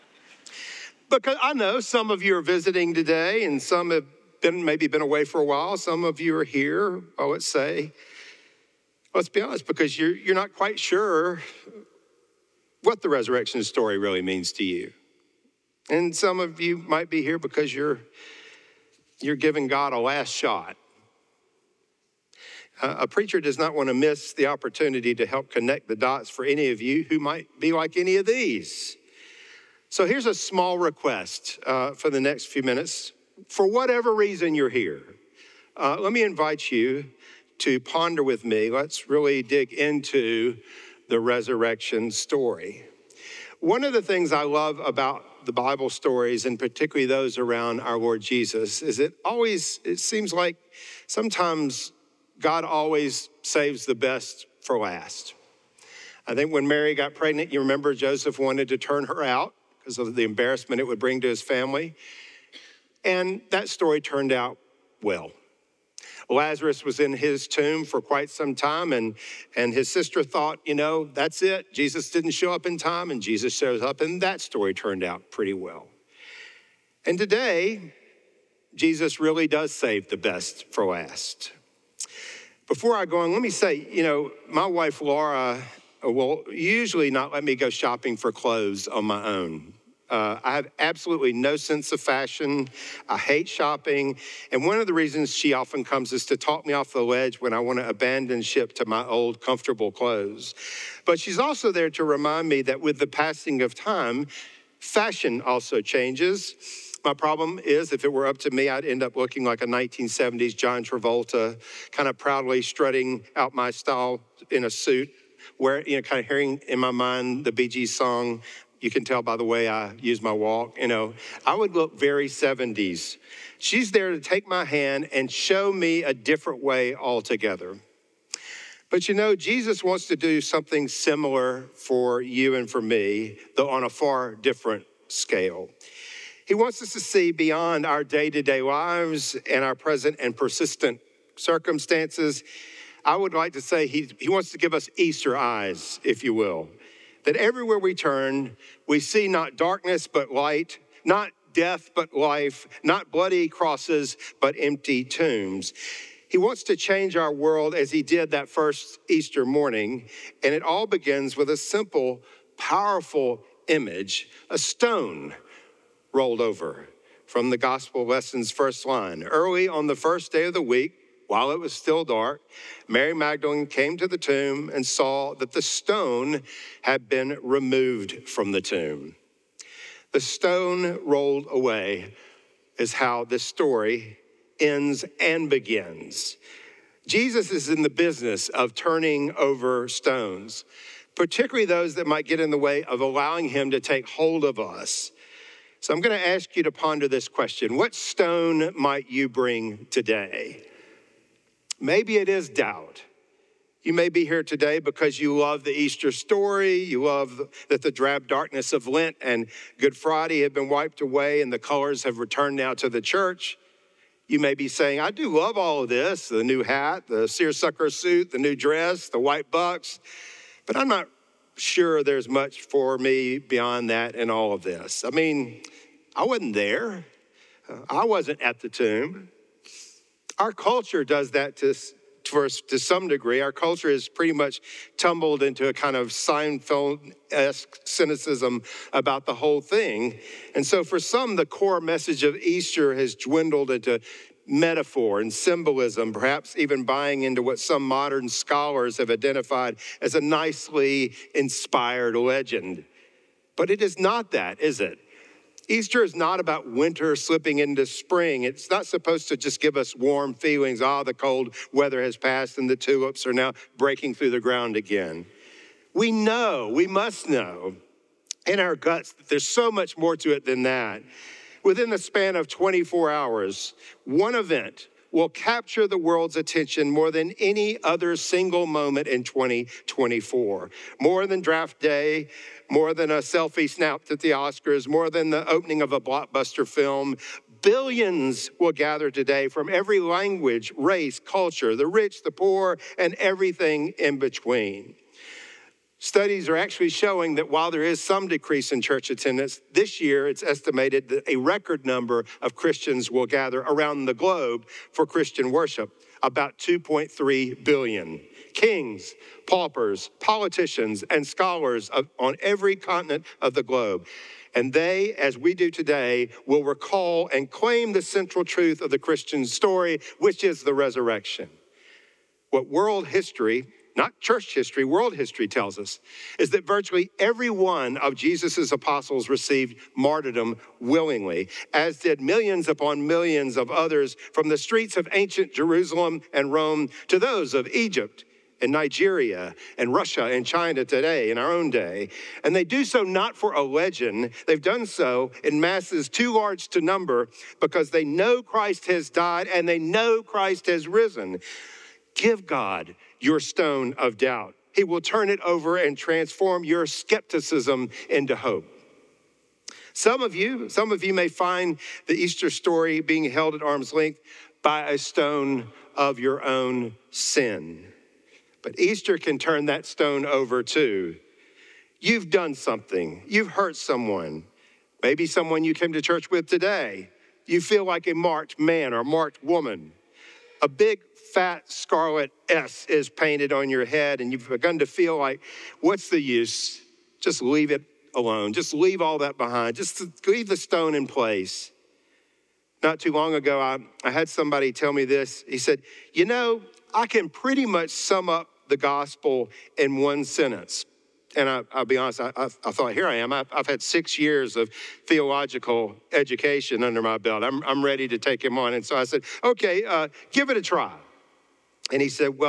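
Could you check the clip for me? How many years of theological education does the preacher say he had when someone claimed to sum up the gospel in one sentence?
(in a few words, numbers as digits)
6.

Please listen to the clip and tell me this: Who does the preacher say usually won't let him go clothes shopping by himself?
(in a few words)
Laura.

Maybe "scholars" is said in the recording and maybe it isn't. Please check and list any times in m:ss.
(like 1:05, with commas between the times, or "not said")
4:08, 5:11.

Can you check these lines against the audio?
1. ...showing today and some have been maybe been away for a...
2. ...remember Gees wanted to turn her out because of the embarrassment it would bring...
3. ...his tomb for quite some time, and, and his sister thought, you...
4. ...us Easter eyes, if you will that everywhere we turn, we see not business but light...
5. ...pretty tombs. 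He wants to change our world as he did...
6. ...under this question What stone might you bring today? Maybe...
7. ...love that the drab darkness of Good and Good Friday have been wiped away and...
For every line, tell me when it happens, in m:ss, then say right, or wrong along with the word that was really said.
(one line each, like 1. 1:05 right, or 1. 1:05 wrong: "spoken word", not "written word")
1. 0:02 wrong: "visiting", not "showing"
2. 0:57 wrong: "Joseph", not "Gees"
3. 1:07 right
4. 2:24 wrong: "darkness", not "business"
5. 2:34 wrong: "empty", not "pretty"
6. 3:16 wrong: "ponder", not "under"
7. 3:27 wrong: "Lent", not "Good".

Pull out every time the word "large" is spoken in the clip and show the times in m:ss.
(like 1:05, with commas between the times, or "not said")
5:46.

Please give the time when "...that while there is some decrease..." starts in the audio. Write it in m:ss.
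4:57.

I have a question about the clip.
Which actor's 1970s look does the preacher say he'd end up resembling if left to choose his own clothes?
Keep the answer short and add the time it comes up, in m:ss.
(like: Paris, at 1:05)
John Travolta, at 1:50.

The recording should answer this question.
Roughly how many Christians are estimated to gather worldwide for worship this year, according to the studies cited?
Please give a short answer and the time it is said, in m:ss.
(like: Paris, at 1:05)
2.3 billion, at 5:06.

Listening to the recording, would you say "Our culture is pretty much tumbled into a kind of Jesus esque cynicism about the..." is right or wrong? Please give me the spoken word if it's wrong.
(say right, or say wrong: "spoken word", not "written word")
wrong: "Seinfeld", not "Jesus".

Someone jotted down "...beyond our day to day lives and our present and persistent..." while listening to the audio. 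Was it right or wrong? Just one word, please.
right.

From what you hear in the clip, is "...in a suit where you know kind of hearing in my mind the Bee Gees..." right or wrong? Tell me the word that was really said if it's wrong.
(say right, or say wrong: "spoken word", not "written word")
right.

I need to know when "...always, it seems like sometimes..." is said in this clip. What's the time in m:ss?
0:49.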